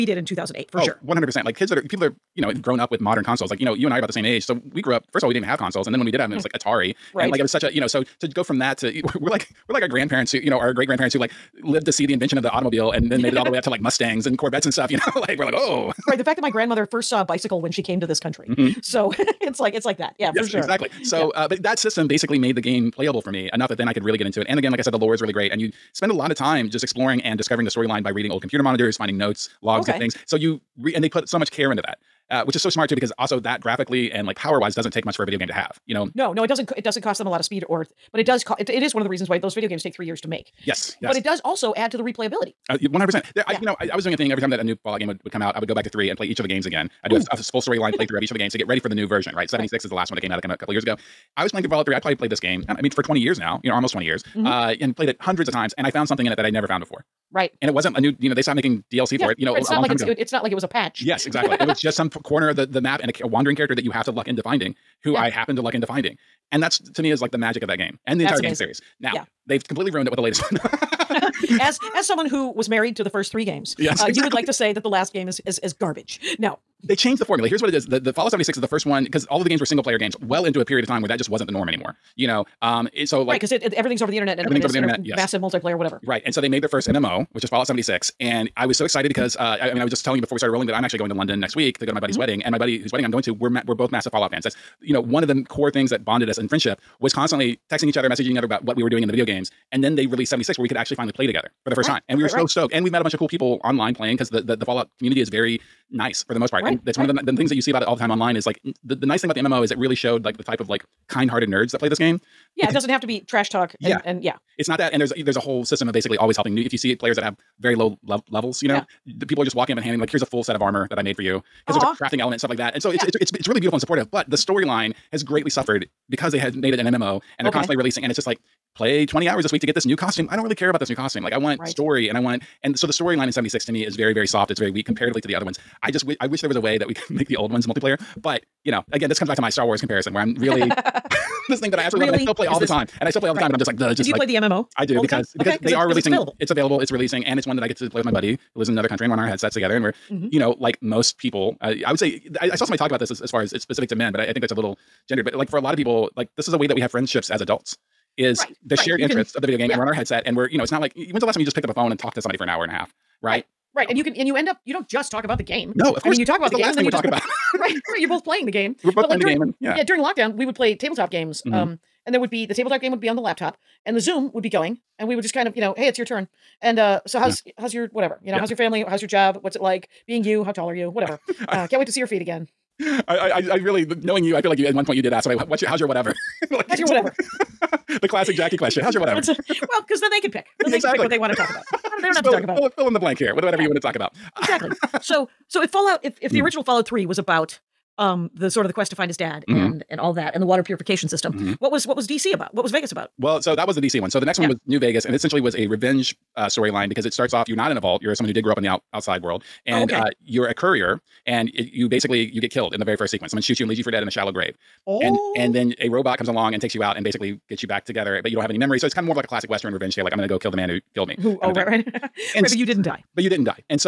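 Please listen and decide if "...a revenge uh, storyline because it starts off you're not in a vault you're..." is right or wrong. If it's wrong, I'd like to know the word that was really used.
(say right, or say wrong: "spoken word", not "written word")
right.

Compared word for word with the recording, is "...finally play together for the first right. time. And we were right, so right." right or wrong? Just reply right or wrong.
right.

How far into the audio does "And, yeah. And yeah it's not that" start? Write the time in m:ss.
1:53.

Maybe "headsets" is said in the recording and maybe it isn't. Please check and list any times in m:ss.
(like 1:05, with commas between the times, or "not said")
2:29, 2:39.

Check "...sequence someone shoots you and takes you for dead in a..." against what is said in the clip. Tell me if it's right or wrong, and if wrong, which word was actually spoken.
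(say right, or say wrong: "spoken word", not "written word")
wrong: "leaves", not "takes".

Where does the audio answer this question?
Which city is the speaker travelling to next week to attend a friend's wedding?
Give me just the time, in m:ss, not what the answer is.
1:31.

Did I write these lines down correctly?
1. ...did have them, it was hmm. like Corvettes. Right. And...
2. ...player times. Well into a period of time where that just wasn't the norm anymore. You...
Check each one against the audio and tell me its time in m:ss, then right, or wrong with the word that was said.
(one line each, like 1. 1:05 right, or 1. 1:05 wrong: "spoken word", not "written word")
1. 0:06 wrong: "Atari", not "Corvettes"
2. 1:19 wrong: "games", not "times".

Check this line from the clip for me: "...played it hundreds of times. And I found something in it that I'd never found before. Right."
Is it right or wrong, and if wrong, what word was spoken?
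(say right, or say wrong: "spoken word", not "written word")
right.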